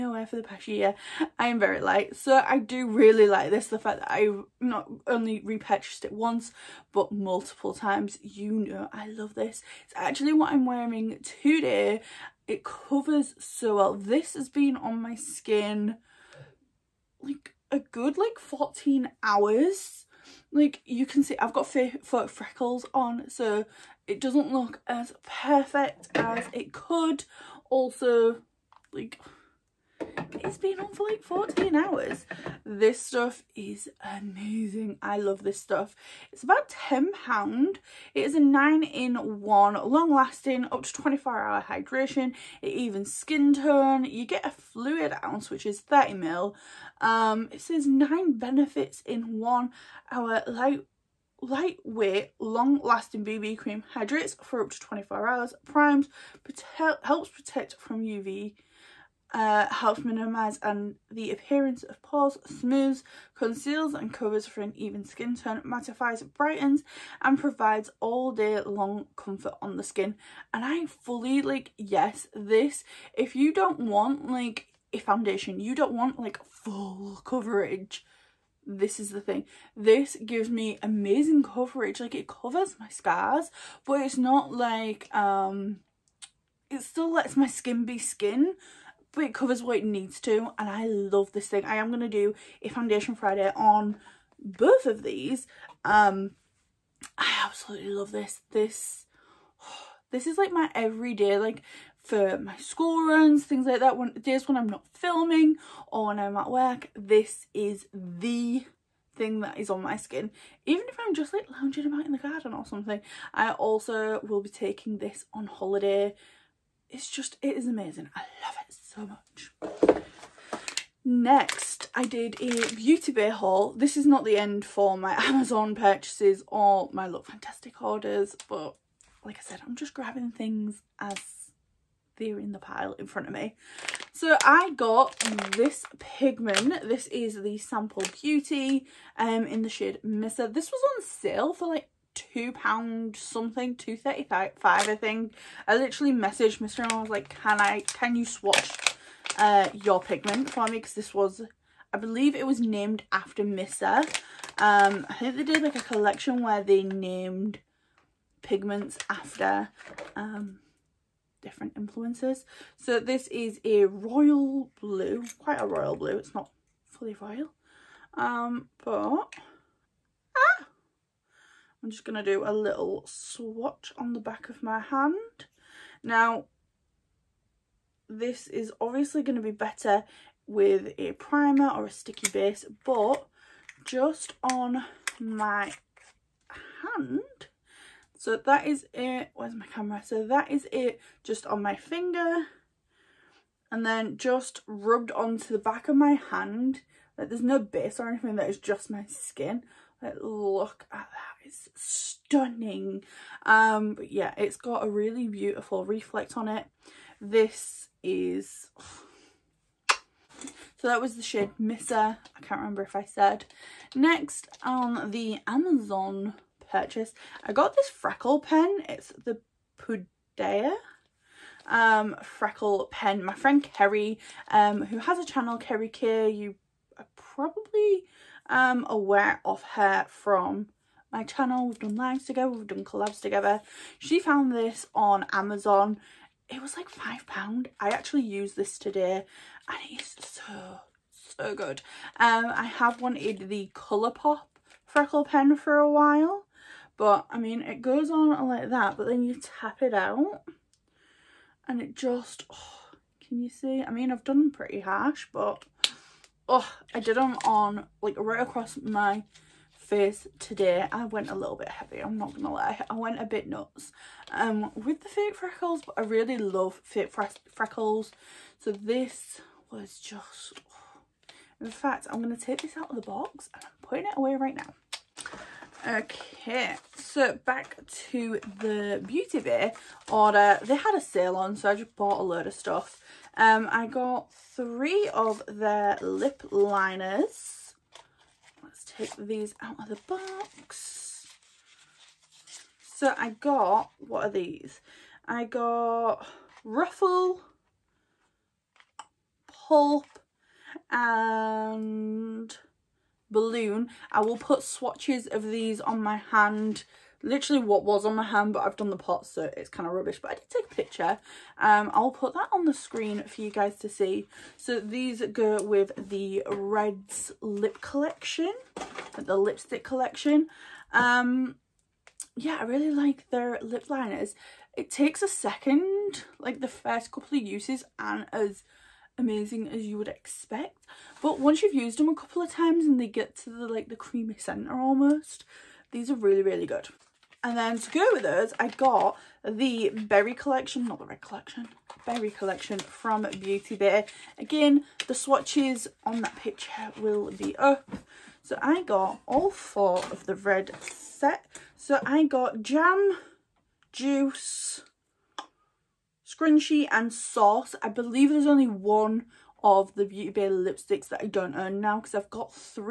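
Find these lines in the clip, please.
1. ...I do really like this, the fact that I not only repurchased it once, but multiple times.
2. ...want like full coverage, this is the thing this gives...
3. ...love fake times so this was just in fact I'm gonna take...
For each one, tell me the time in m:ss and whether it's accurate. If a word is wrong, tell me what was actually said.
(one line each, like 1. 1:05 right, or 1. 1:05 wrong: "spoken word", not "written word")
1. 0:02 right
2. 1:15 right
3. 4:26 wrong: "freckles", not "times".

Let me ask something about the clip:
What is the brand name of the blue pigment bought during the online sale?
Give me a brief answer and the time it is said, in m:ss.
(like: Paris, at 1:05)
Sample Beauty, at 2:17.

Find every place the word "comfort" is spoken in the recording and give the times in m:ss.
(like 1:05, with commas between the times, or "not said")
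1:09.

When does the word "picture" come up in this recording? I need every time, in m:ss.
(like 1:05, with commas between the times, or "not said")
5:10, 5:46.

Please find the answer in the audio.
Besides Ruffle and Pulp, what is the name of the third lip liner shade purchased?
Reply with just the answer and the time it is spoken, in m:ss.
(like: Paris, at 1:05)
Balloon, at 5:03.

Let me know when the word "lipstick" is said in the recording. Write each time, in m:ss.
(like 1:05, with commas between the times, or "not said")
5:19, 6:00.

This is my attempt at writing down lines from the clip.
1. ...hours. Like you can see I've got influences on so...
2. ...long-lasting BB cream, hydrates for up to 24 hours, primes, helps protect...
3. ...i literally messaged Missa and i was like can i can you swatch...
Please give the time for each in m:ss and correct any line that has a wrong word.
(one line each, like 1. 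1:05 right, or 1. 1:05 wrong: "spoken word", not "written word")
1. 0:19 wrong: "freckles", not "influences"
2. 0:52 right
3. 2:25 right.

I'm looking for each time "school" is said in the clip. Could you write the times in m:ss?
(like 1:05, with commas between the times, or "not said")
1:42.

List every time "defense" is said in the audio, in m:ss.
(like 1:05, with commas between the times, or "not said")
not said.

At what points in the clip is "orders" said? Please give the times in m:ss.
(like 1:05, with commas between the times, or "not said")
2:07, 4:40.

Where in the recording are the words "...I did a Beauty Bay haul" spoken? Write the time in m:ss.
2:01.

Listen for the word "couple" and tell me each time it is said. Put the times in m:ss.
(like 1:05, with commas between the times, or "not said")
5:27, 5:32.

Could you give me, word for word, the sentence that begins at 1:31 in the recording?
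I am going to do a foundation Friday on both of these.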